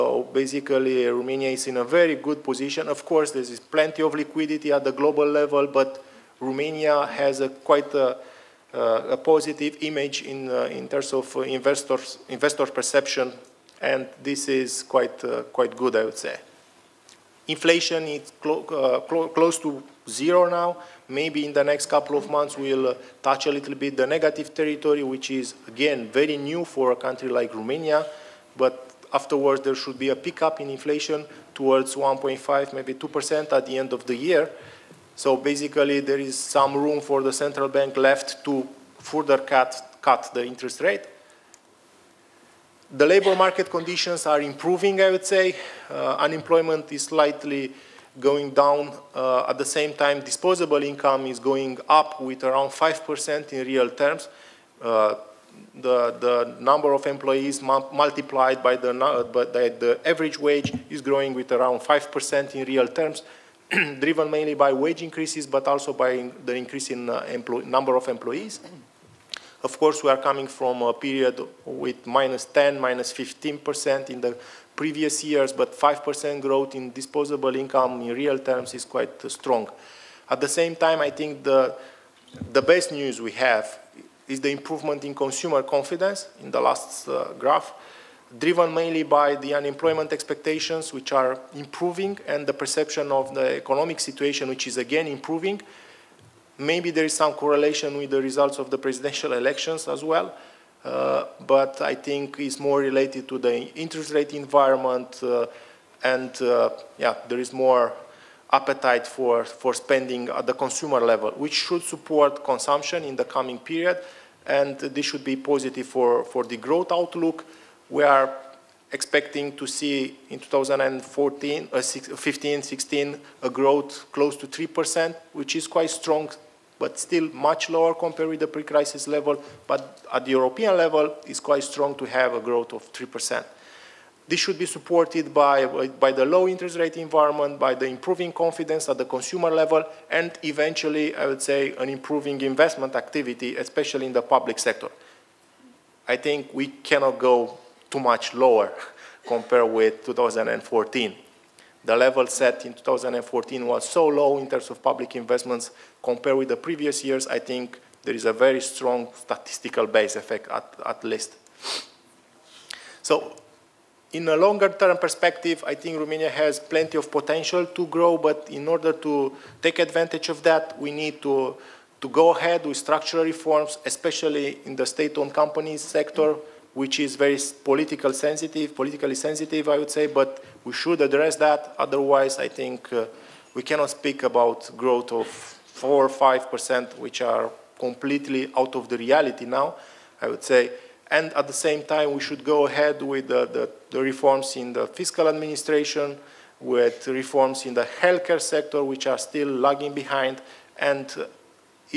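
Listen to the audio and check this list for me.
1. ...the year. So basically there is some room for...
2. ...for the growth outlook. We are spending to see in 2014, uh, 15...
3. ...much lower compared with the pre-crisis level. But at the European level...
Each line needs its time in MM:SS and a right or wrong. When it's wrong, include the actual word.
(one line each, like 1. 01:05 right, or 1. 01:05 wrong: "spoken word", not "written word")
1. 00:34 right
2. 01:56 wrong: "expecting", not "spending"
3. 02:07 right.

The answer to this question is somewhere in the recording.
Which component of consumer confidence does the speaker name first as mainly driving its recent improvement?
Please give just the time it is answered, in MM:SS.
01:29.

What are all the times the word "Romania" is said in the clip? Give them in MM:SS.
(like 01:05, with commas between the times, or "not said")
00:01, 00:06, 00:27, 02:45.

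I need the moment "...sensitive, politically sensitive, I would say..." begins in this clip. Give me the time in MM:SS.
02:58.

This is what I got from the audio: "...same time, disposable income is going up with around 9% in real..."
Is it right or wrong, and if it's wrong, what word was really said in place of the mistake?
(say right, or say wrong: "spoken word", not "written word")
wrong: "5", not "9".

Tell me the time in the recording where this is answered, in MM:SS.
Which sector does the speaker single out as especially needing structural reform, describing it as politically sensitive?
02:54.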